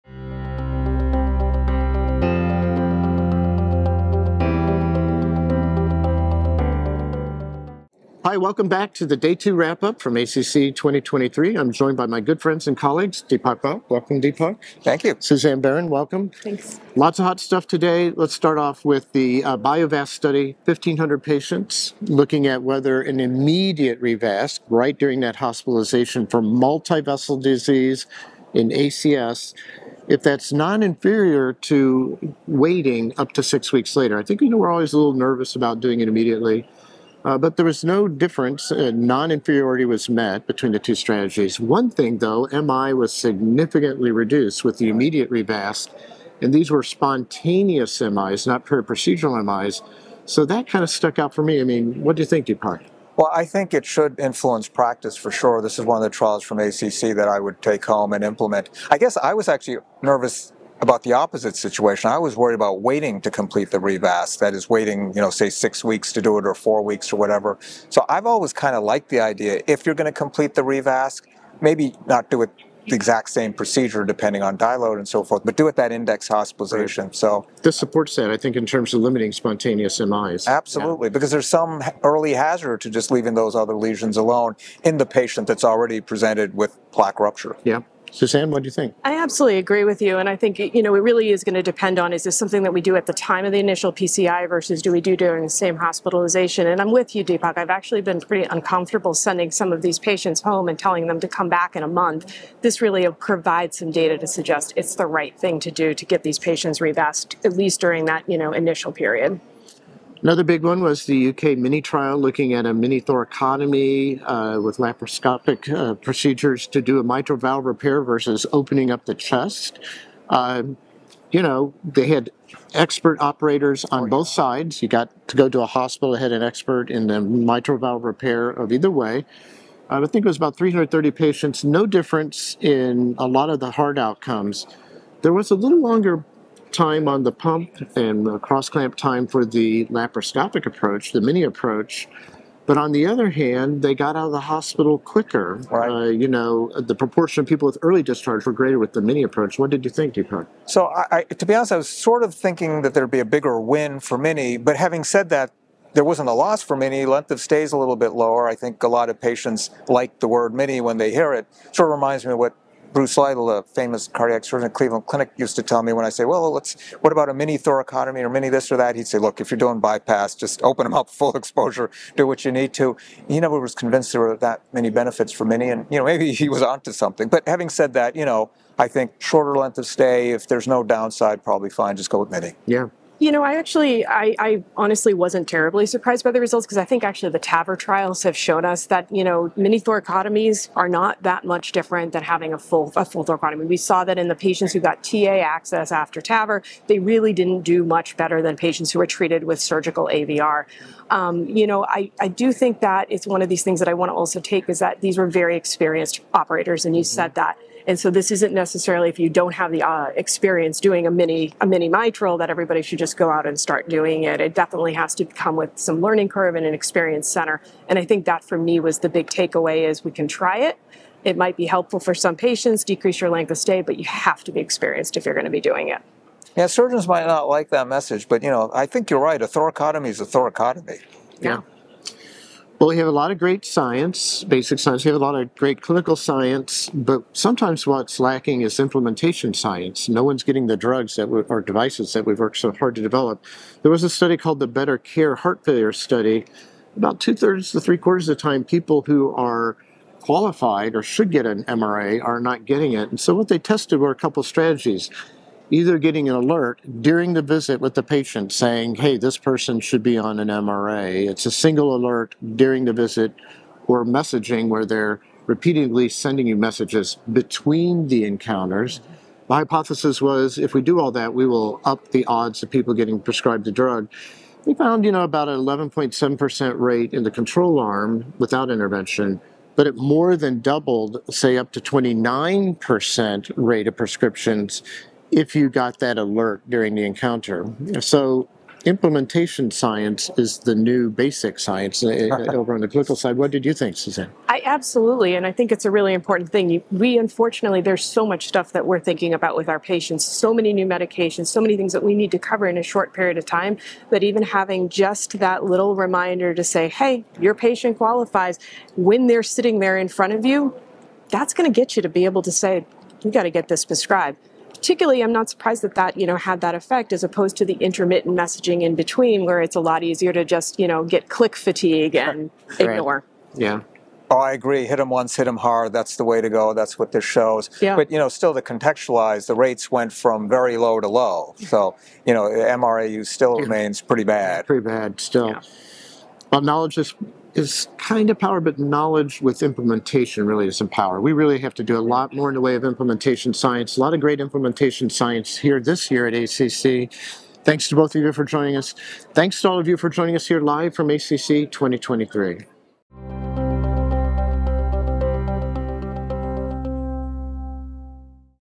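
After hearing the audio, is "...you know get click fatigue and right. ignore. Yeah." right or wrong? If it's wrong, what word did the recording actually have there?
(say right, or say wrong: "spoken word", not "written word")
right.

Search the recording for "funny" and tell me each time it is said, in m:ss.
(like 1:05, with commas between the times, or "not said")
not said.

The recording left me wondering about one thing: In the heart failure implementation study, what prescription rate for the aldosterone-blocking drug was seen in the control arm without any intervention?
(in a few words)
11.7%.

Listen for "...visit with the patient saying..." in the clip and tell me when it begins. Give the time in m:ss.
4:17.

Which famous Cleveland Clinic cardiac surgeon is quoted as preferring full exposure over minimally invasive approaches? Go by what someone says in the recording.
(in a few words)
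Bruce Lytle.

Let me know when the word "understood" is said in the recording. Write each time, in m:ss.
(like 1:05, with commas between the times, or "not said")
not said.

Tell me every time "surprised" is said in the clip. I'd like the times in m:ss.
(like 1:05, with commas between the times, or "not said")
3:05, 5:15.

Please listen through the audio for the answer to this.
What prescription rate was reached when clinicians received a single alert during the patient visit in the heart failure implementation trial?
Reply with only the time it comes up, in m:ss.
4:41.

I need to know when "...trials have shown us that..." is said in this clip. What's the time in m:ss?
3:07.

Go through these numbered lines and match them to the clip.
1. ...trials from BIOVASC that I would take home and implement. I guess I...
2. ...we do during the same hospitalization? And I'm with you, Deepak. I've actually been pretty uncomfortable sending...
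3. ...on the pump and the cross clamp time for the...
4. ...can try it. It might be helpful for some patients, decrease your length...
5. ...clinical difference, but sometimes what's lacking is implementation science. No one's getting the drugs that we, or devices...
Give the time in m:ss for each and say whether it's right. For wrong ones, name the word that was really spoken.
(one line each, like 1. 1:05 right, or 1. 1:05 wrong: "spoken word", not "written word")
1. 0:56 wrong: "ACC", not "BIOVASC"
2. 1:34 right
3. 2:17 right
4. 3:40 right
5. 3:55 wrong: "science", not "difference".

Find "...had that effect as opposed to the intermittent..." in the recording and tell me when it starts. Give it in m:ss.
5:16.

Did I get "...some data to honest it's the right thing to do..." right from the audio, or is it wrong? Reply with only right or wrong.
wrong.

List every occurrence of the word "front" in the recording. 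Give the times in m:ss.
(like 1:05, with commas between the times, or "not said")
5:10.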